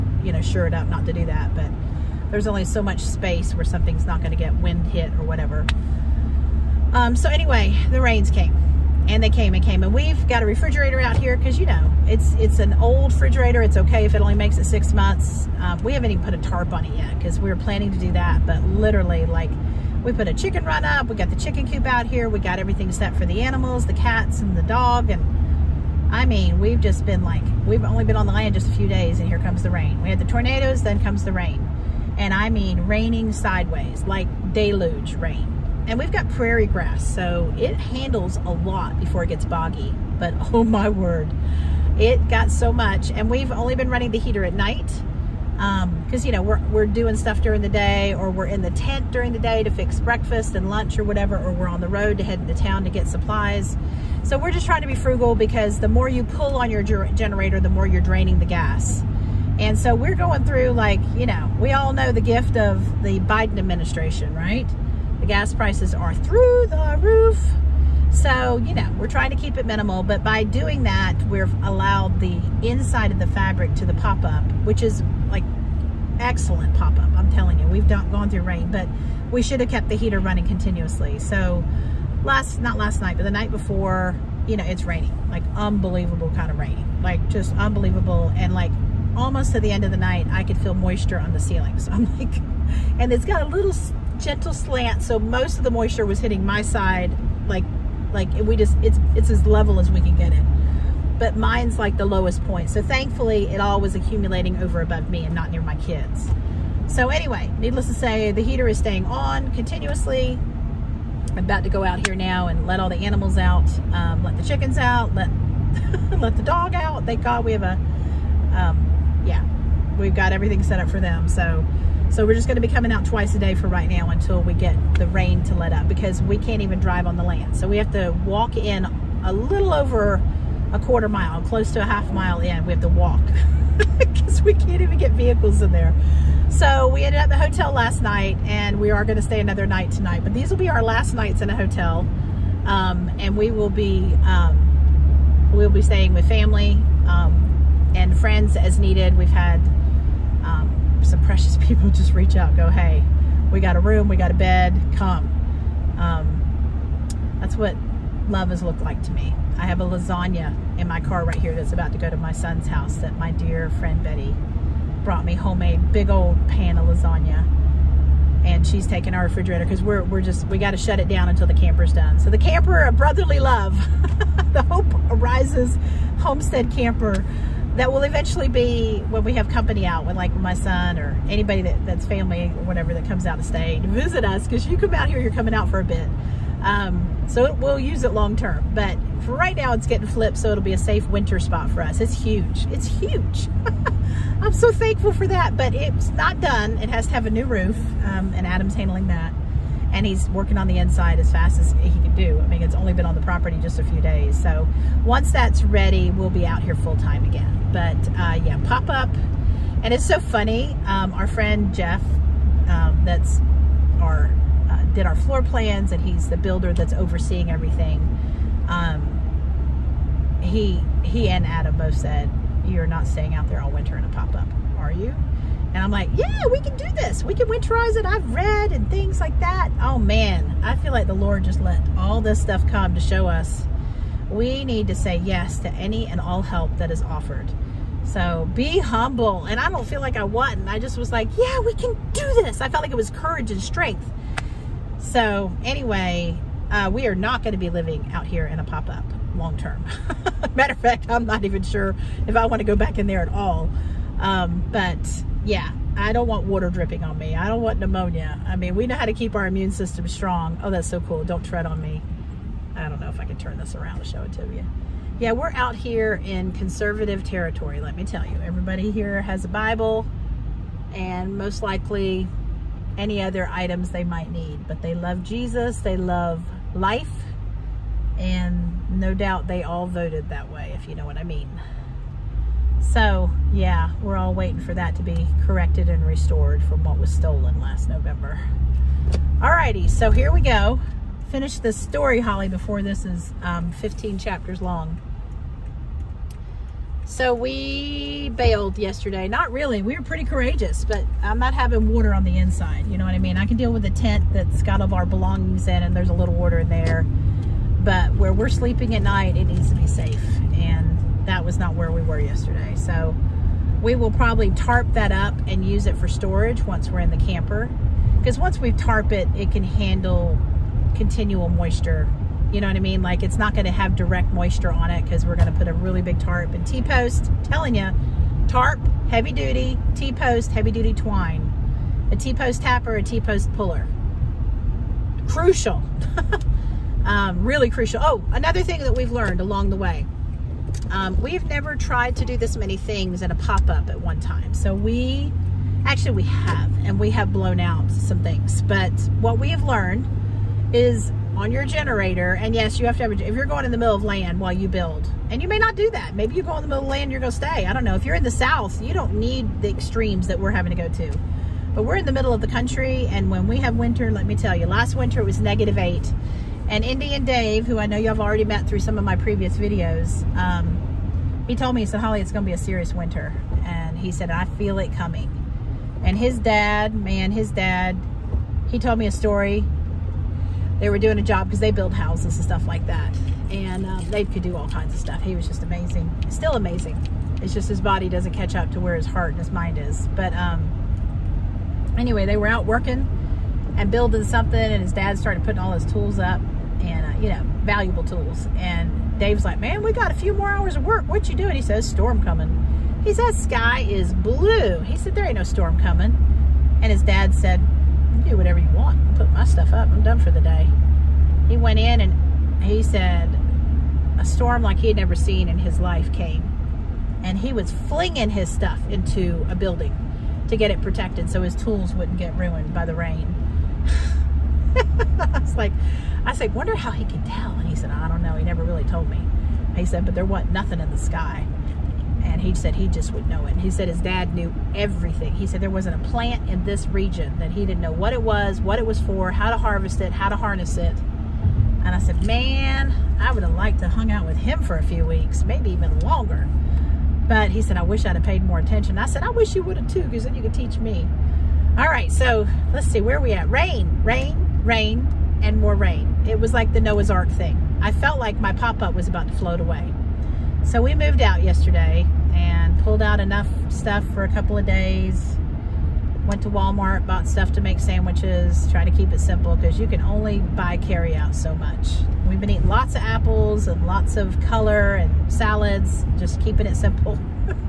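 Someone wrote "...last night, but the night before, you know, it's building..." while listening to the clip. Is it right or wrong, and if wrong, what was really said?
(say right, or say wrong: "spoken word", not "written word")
wrong: "raining", not "building".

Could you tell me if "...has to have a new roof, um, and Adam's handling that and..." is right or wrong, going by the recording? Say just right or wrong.
right.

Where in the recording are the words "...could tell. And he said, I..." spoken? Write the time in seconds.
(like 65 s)
427 s.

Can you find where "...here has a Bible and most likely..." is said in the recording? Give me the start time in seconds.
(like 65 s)
268 s.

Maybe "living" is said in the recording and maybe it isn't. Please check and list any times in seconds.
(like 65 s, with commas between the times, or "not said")
247 s.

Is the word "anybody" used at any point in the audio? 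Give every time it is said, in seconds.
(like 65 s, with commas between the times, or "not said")
181 s.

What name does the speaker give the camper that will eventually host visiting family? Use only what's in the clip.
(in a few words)
Hope Arises Homestead Camper.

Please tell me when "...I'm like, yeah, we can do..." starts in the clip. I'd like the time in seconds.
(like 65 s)
225 s.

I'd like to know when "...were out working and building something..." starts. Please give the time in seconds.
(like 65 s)
392 s.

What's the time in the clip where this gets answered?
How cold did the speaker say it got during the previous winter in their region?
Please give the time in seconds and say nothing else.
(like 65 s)
365 s.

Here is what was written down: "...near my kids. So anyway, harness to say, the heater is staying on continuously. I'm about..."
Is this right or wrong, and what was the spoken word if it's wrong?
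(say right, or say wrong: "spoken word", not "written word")
wrong: "needless", not "harness".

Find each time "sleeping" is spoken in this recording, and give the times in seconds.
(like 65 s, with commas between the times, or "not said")
308 s.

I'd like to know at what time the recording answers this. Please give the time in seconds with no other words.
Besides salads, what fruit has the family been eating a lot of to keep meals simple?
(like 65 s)
473 s.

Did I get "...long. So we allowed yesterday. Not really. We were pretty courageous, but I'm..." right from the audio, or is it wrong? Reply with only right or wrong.
wrong.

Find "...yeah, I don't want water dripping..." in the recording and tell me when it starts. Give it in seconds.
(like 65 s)
255 s.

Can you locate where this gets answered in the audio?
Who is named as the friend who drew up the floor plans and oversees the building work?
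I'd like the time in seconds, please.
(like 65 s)
211 s.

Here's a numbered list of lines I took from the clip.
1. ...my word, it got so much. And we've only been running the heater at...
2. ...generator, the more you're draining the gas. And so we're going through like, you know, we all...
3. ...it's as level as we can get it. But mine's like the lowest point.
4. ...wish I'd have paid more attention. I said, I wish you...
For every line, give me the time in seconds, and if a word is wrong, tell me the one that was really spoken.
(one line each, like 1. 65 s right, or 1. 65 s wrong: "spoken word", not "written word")
1. 40 s right
2. 56 s right
3. 99 s right
4. 447 s right.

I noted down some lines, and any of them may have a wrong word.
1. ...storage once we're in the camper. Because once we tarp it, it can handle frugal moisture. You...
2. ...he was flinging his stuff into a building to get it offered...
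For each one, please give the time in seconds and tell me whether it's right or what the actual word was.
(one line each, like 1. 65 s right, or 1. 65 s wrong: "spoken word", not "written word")
1. 316 s wrong: "continual", not "frugal"
2. 417 s wrong: "protected", not "offered".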